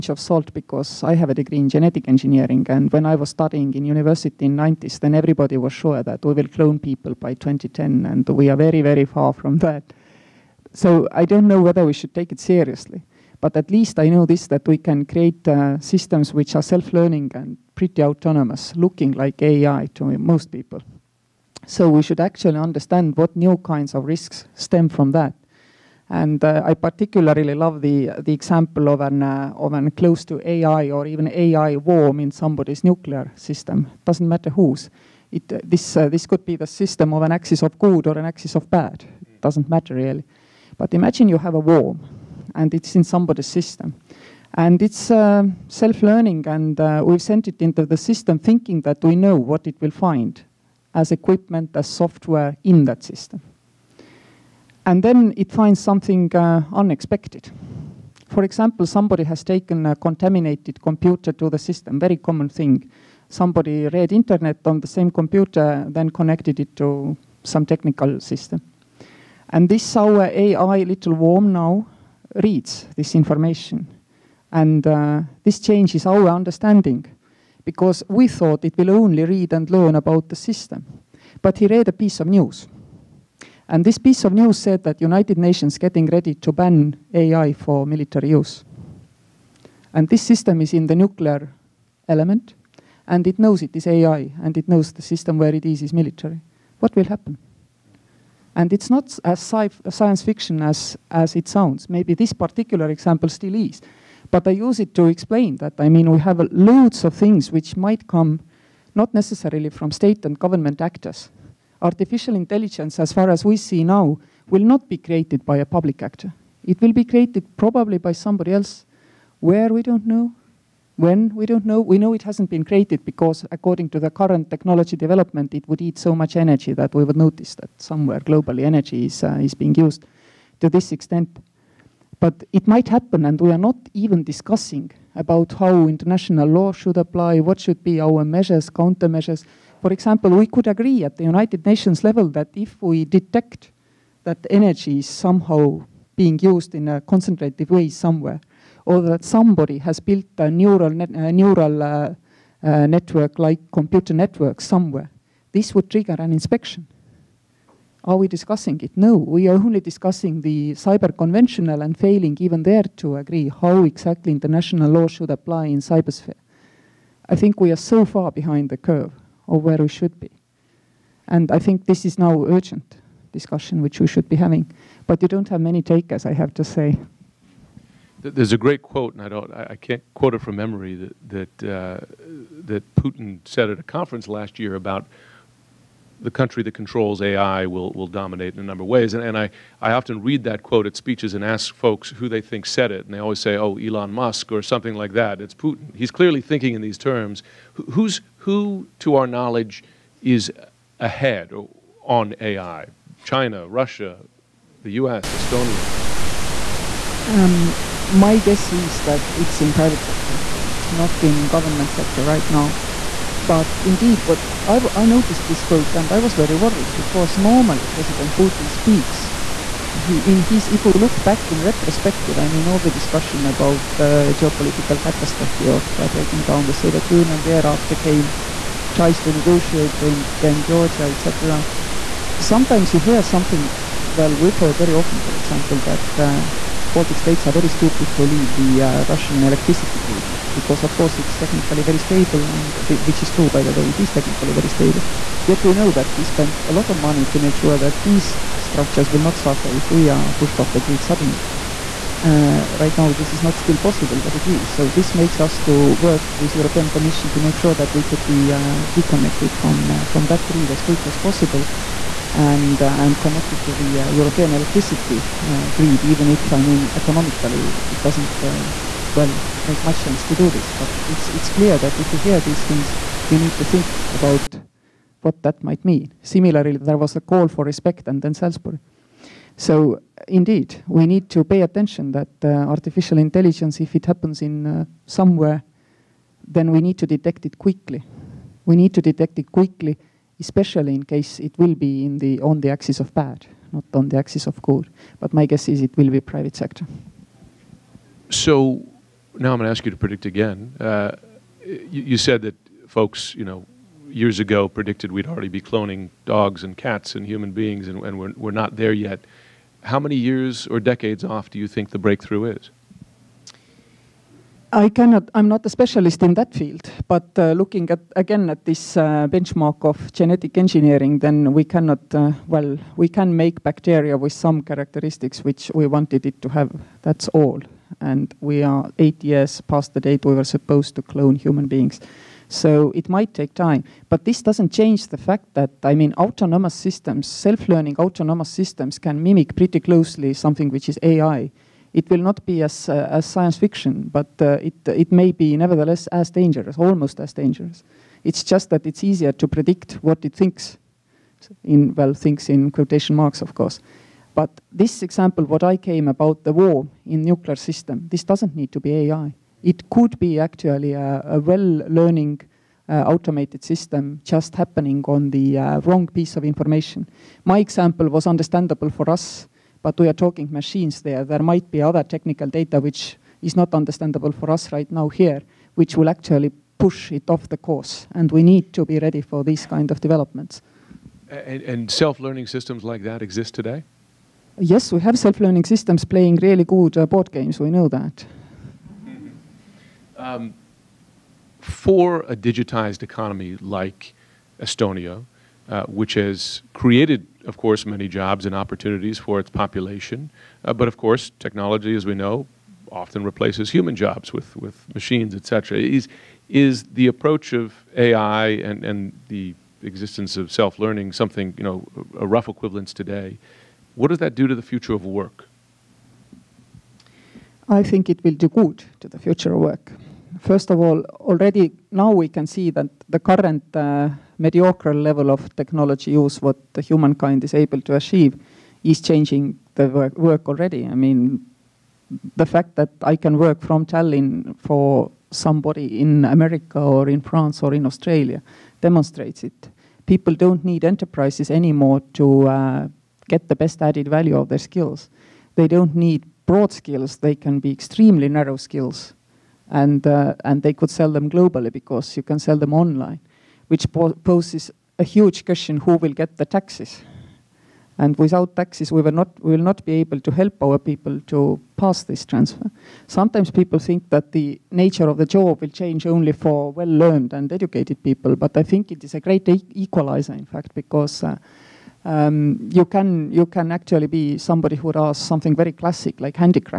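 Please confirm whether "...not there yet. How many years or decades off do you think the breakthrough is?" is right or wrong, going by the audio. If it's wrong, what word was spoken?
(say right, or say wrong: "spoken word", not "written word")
right.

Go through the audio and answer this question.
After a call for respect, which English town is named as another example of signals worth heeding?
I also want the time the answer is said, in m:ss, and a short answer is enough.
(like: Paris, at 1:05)
Salisbury, at 4:38.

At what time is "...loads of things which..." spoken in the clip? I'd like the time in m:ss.
1:46.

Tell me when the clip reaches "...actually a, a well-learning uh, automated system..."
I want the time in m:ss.
6:00.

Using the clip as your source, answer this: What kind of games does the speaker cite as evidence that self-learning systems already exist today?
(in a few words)
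Board games.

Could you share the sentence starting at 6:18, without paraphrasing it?
And we need to be ready for these kind of developments.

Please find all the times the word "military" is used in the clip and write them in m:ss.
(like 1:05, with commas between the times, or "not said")
1:27, 1:35.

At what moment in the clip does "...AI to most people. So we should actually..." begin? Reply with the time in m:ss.
0:19.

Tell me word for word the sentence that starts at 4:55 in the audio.
But my guess is it will be private sector.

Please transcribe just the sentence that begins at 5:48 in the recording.
It's just that it's easier to predict what it thinks, in, well, thinks in quotation marks, of course.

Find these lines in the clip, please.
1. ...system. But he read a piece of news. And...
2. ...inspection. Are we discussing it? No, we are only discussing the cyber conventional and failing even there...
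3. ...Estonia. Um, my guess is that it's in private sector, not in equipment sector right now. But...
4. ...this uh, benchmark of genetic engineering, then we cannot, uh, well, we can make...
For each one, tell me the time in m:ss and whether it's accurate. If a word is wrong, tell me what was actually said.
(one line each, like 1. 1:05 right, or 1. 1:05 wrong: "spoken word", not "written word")
1. 1:20 right
2. 2:36 right
3. 3:25 wrong: "government", not "equipment"
4. 5:18 right.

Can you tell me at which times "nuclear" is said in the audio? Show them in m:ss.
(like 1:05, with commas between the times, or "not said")
0:32, 1:30, 5:57.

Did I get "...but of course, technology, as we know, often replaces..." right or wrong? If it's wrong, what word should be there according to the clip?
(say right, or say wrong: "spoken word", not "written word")
right.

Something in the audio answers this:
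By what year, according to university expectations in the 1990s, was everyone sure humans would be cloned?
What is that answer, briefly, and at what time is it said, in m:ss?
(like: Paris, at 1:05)
2010, at 0:07.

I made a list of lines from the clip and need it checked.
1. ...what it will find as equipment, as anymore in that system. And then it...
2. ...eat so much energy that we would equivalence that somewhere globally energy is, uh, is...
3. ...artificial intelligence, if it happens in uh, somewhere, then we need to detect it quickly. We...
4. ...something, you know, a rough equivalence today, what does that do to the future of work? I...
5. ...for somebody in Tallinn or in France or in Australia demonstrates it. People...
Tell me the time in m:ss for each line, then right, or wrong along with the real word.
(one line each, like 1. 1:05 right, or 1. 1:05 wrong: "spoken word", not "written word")
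1. 0:49 wrong: "software", not "anymore"
2. 2:05 wrong: "notice", not "equivalence"
3. 4:42 right
4. 6:51 right
5. 7:14 wrong: "America", not "Tallinn".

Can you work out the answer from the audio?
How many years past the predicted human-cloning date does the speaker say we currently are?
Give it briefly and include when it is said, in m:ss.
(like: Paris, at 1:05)
8, at 5:28.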